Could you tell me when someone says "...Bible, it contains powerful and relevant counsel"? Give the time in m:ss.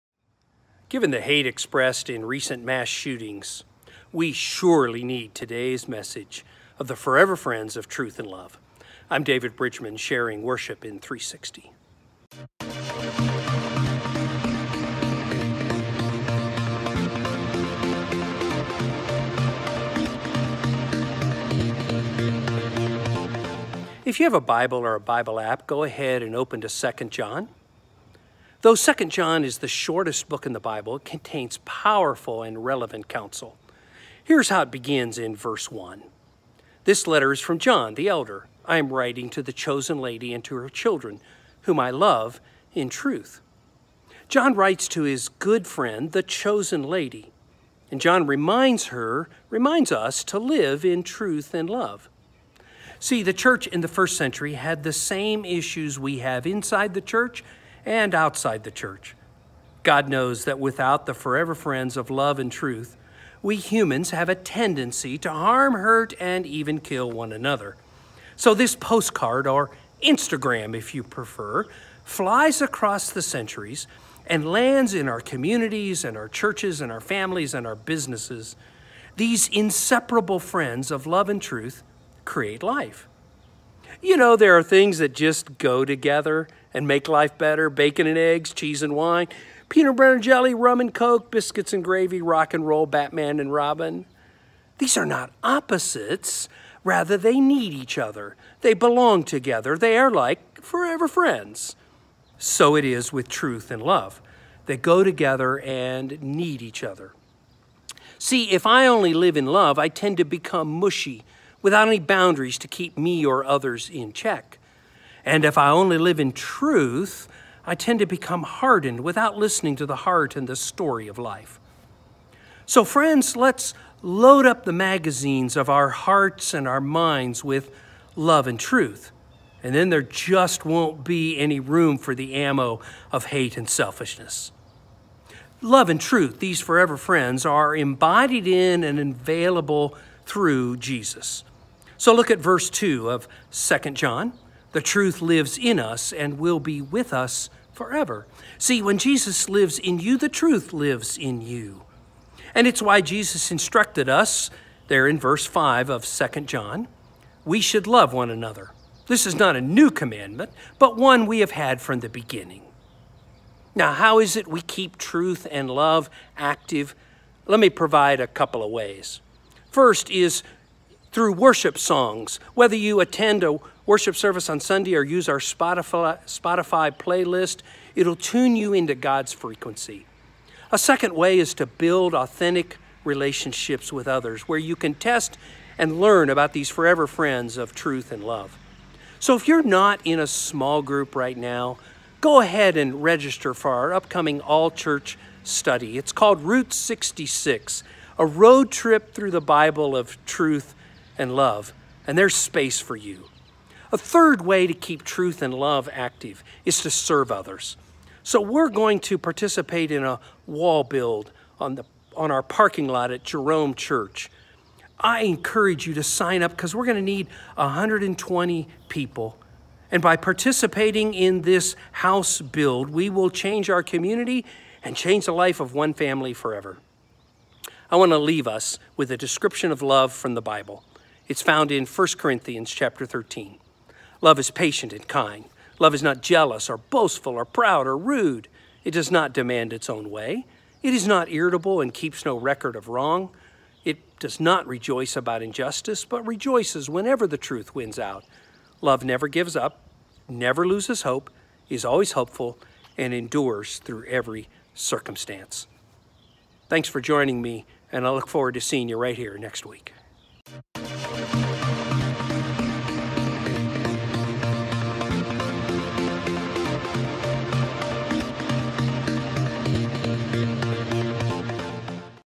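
0:30.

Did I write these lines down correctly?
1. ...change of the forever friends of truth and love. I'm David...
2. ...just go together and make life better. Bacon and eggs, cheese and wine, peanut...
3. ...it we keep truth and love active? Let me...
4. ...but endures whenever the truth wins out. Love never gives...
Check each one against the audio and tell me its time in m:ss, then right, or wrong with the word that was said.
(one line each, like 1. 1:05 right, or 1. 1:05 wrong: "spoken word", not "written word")
1. 0:05 wrong: "message", not "change"
2. 1:25 right
3. 2:44 right
4. 4:06 wrong: "rejoices", not "endures".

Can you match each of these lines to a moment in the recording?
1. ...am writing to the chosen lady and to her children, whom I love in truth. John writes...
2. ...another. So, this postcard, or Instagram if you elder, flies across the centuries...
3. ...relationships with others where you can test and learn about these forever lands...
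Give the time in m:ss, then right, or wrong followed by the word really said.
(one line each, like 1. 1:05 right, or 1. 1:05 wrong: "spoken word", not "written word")
1. 0:38 right
2. 1:07 wrong: "prefer", not "elder"
3. 3:03 wrong: "friends", not "lands".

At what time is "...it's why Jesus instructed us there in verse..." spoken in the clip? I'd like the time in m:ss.
2:32.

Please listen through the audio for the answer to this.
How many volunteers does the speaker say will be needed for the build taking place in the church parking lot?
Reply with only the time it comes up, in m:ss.
3:37.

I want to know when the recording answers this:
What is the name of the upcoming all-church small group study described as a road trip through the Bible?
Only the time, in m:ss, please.
3:16.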